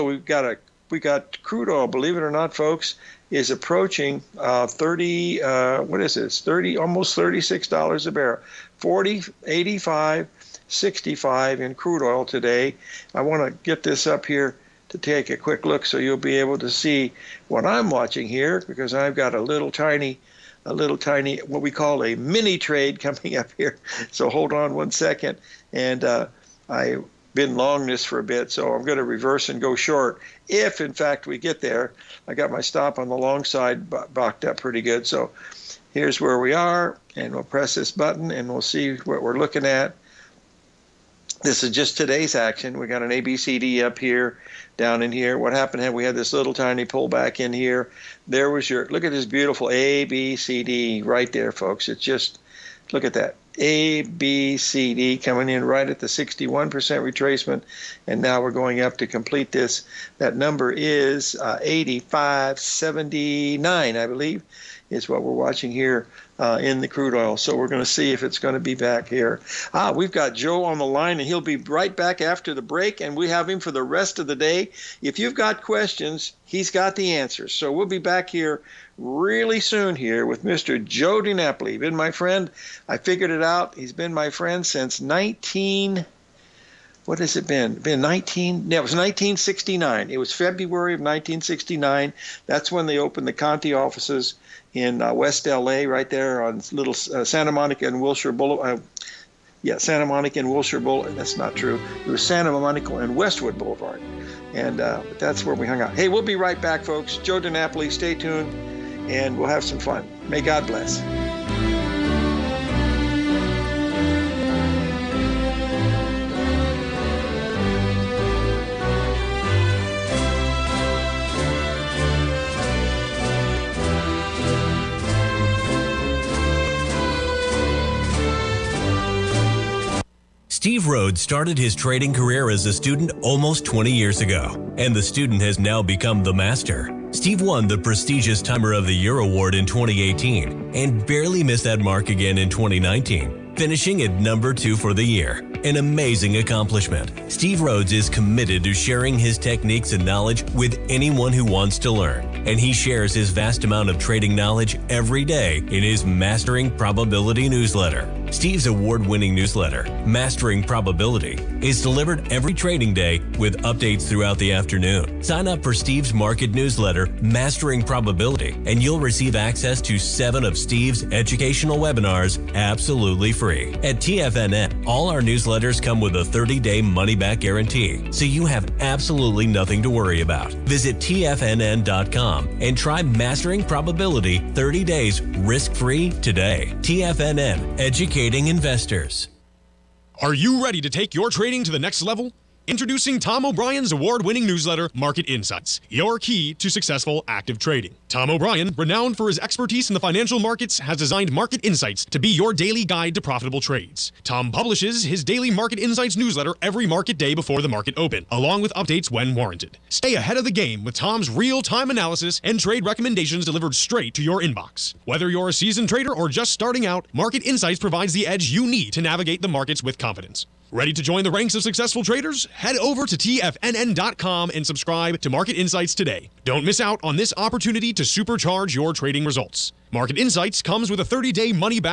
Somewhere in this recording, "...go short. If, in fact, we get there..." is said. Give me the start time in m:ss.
0:29.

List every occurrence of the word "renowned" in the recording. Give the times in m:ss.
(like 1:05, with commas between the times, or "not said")
3:18.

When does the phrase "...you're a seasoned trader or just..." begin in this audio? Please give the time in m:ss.
3:35.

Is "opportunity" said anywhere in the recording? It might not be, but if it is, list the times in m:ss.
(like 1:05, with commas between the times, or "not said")
3:47.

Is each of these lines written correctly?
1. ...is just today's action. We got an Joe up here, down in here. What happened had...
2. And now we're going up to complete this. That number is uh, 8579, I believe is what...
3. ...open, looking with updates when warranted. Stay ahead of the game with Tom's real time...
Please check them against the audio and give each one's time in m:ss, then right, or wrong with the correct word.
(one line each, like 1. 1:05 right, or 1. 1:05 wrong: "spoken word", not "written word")
1. 0:41 wrong: "ABCD", not "Joe"
2. 0:58 right
3. 3:27 wrong: "along", not "looking".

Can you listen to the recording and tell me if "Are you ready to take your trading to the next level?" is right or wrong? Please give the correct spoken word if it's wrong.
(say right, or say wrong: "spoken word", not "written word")
right.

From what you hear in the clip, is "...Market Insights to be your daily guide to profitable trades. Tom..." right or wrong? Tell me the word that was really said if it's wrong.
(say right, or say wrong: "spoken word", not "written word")
right.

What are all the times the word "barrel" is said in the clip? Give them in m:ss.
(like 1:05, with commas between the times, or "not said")
0:08.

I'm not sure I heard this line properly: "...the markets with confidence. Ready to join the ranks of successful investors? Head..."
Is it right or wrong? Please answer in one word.
wrong.